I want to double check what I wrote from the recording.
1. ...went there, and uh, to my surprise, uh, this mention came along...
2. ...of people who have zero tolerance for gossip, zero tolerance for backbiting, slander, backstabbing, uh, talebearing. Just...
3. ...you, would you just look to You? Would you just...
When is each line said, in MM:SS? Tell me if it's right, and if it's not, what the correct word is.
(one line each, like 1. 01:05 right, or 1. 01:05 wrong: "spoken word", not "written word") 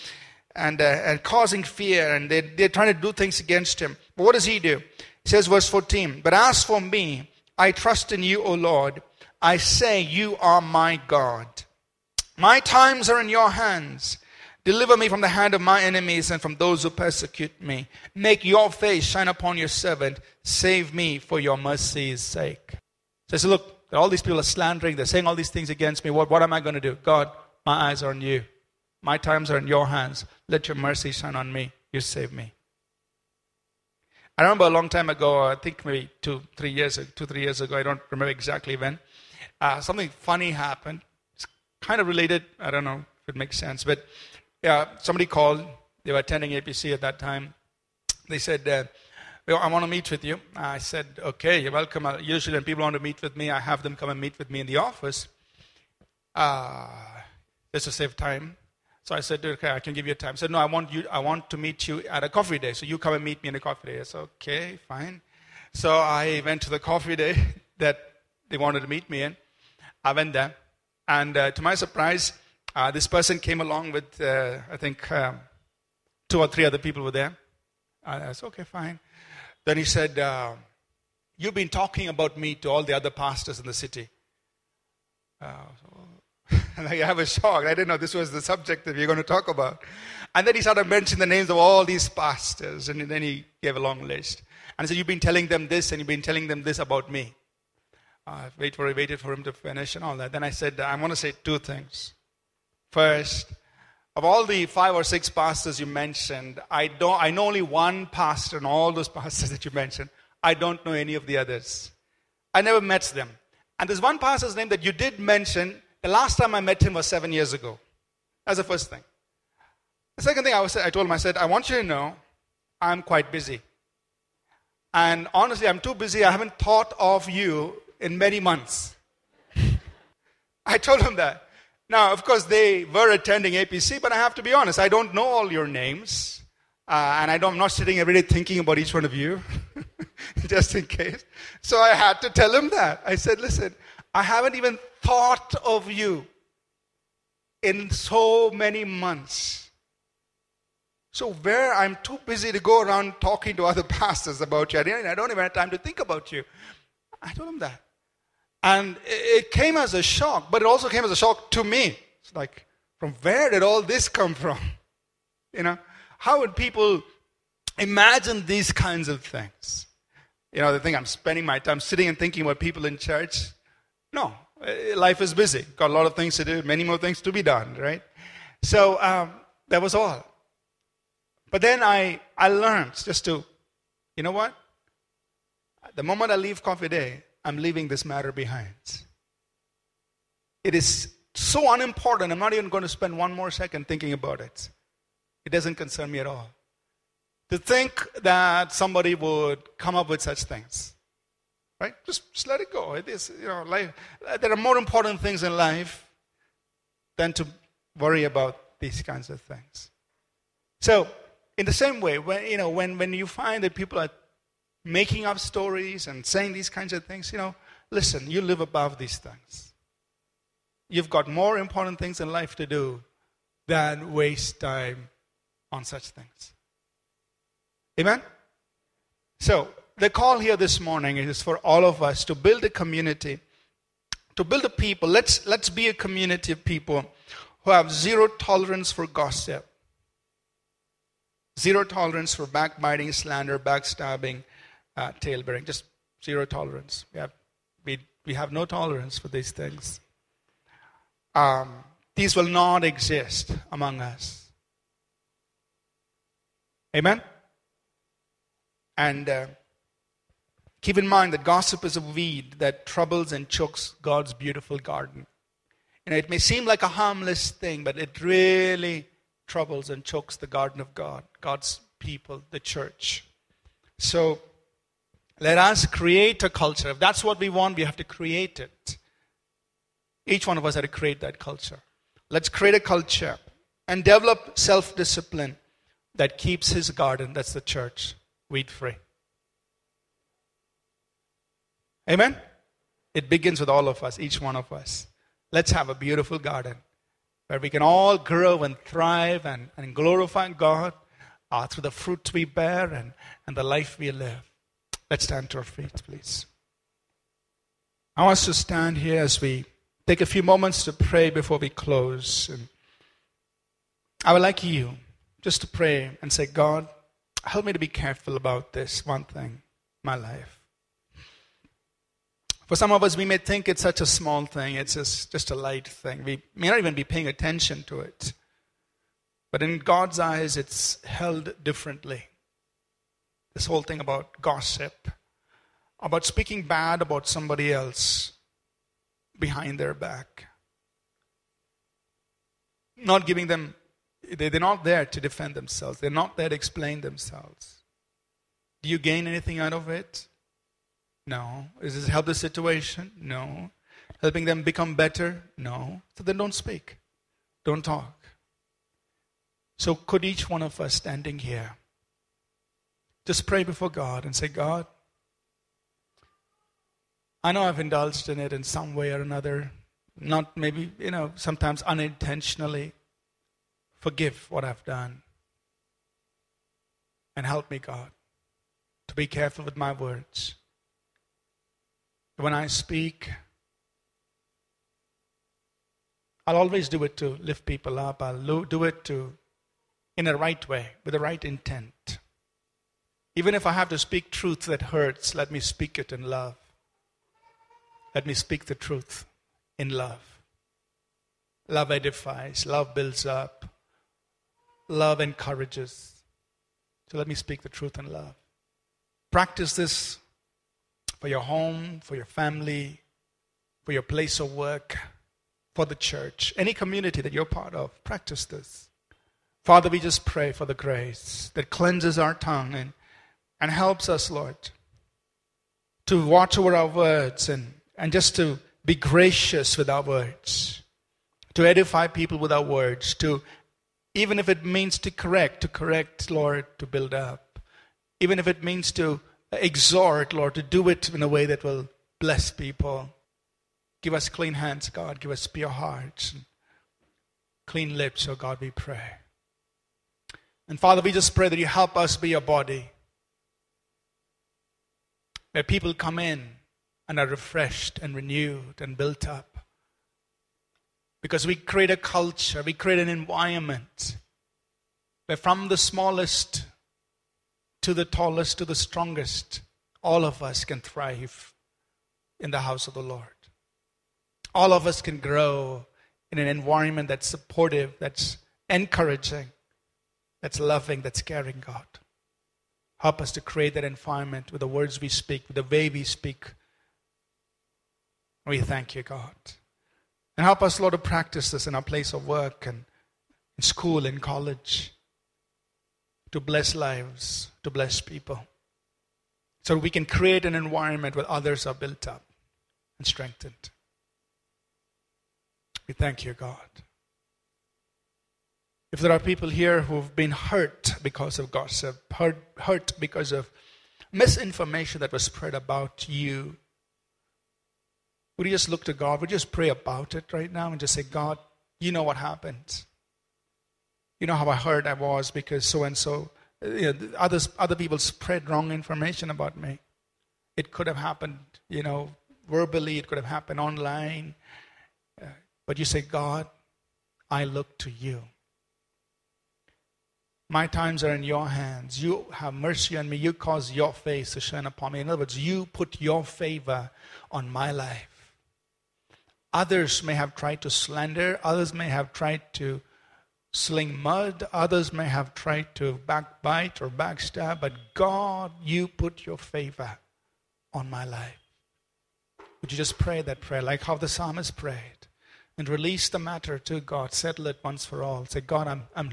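1. 01:10 wrong: "person", not "mention"
2. 03:56 right
3. 08:36 wrong: "God", not "You".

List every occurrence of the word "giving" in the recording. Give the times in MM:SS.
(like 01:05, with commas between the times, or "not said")
05:43.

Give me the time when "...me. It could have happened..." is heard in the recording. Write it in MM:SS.
08:49.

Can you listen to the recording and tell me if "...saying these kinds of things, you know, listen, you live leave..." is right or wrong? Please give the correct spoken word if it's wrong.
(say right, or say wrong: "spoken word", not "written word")
wrong: "above", not "leave".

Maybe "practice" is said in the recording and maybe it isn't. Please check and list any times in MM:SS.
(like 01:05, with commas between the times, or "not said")
06:49, 06:58, 08:10.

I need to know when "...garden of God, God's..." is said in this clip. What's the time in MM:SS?
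04:30.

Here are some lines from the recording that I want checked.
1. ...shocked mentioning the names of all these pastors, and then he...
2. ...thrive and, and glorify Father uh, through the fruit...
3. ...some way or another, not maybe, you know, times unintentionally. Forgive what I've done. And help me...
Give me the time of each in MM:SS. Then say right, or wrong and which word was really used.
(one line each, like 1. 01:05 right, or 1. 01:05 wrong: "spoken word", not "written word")
1. 01:30 wrong: "started", not "shocked"
2. 04:58 wrong: "God", not "Father"
3. 06:08 wrong: "sometimes", not "times".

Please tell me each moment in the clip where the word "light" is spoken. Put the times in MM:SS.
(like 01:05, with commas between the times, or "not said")
05:25.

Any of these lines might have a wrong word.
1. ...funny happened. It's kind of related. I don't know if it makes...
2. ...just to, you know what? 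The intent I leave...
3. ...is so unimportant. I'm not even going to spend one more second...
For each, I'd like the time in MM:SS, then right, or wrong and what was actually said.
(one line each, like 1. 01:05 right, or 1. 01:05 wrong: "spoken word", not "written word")
1. 00:40 right
2. 03:02 wrong: "moment", not "intent"
3. 03:10 right.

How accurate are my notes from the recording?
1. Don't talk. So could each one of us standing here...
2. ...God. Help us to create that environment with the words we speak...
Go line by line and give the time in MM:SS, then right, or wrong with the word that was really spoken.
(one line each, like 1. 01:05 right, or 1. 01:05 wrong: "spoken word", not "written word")
1. 05:57 right
2. 08:01 right.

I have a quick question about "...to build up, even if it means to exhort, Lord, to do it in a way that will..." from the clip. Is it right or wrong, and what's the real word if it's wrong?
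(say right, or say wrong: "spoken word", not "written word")
right.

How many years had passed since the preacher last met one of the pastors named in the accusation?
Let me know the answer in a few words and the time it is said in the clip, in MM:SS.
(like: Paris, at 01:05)
7, at 01:57.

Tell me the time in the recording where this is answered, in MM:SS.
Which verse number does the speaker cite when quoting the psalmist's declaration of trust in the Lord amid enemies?
00:05.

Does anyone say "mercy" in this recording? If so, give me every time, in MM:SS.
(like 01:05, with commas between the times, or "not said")
00:21, 00:30, 09:02.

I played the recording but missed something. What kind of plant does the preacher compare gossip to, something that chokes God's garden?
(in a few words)
A weed.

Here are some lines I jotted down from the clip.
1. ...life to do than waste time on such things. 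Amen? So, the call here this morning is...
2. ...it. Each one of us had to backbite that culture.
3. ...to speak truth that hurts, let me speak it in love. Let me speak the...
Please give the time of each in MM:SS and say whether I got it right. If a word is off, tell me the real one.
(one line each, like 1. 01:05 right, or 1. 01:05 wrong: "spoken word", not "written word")
1. 03:42 right
2. 04:38 wrong: "create", not "backbite"
3. 06:33 right.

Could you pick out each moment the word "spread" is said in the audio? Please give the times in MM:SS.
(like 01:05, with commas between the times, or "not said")
08:35, 08:47.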